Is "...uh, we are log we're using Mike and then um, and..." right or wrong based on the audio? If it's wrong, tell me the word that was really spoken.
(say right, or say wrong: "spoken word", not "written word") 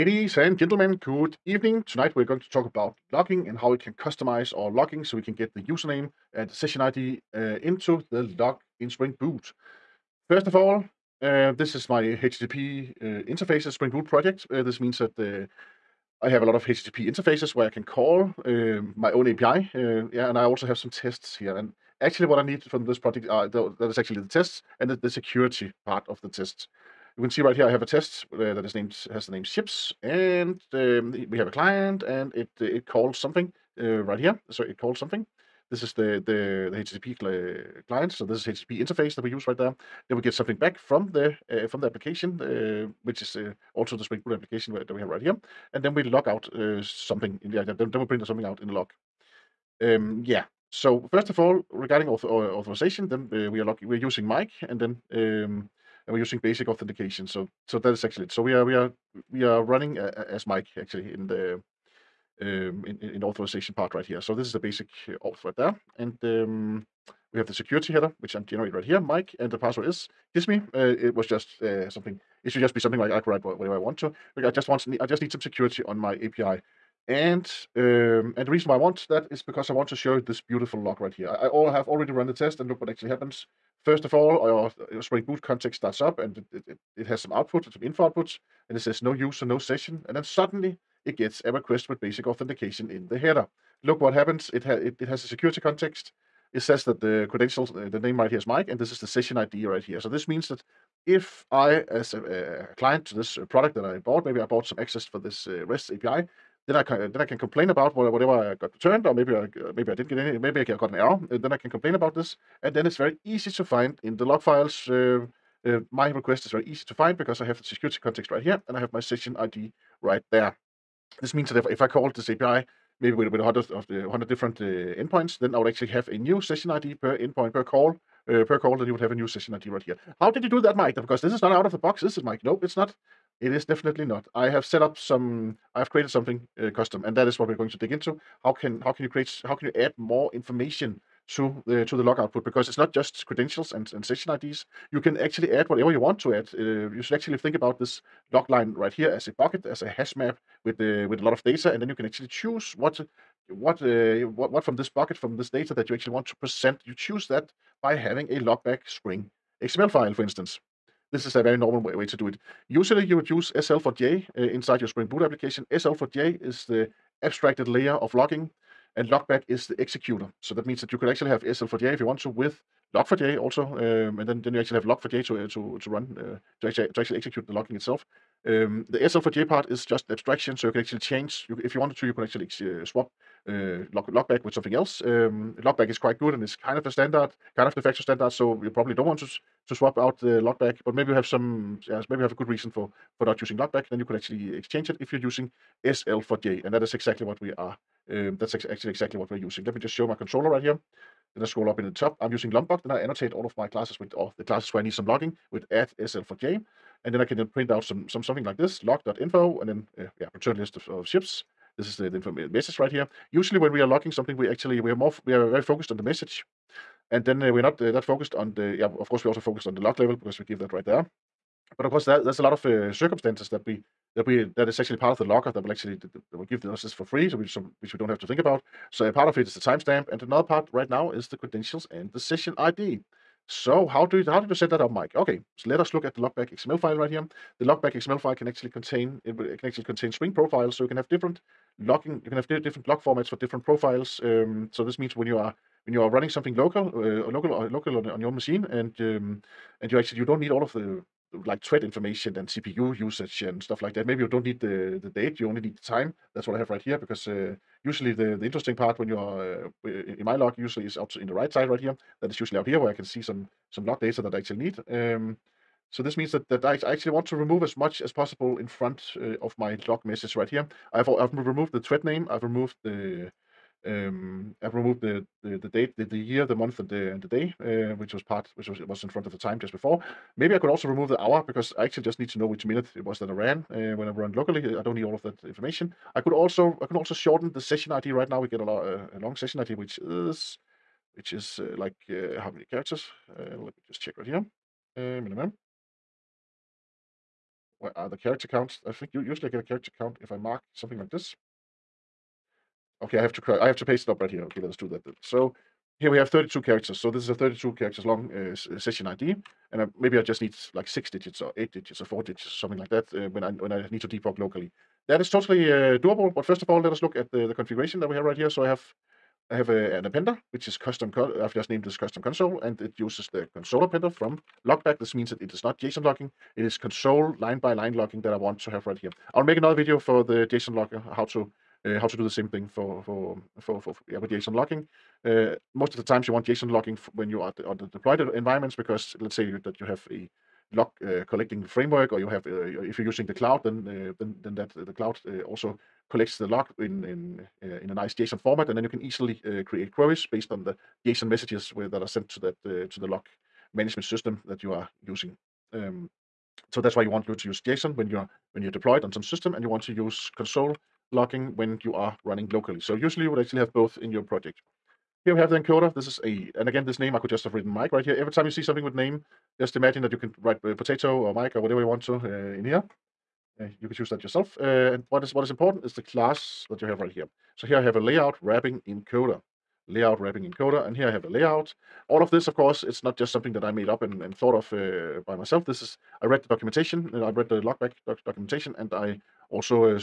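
right.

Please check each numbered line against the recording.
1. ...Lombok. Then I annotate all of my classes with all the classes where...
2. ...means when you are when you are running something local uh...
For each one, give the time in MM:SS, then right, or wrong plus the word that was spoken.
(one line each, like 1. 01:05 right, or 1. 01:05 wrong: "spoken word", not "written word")
1. 03:22 right
2. 04:04 right.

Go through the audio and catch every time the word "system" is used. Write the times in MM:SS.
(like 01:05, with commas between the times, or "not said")
05:54, 05:59.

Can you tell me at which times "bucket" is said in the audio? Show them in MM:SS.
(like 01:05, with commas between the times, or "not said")
02:29, 02:34.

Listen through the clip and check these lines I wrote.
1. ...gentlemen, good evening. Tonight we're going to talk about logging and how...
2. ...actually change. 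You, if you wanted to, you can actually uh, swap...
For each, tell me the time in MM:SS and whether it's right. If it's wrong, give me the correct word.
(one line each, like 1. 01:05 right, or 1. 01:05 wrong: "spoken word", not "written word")
1. 00:00 right
2. 03:00 right.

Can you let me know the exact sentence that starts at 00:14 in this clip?
Uh, this means that uh, I have a lot of HTTP interfaces where I can call um, my own API.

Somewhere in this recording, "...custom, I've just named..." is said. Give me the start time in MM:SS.
05:20.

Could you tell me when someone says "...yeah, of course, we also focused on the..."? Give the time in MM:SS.
03:38.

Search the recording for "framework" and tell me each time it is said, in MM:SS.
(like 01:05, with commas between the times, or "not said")
05:41.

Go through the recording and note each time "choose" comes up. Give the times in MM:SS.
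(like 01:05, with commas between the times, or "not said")
02:32, 02:37, 06:13.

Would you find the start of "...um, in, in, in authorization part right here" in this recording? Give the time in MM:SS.
01:02.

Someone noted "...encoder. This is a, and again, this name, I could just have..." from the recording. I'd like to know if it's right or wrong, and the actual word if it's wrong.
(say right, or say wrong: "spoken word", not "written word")
right.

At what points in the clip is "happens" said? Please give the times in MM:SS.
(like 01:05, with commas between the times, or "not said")
01:23, 01:34.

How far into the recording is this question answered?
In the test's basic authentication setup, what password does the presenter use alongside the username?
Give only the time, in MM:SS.
01:10.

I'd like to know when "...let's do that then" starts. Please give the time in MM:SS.
05:04.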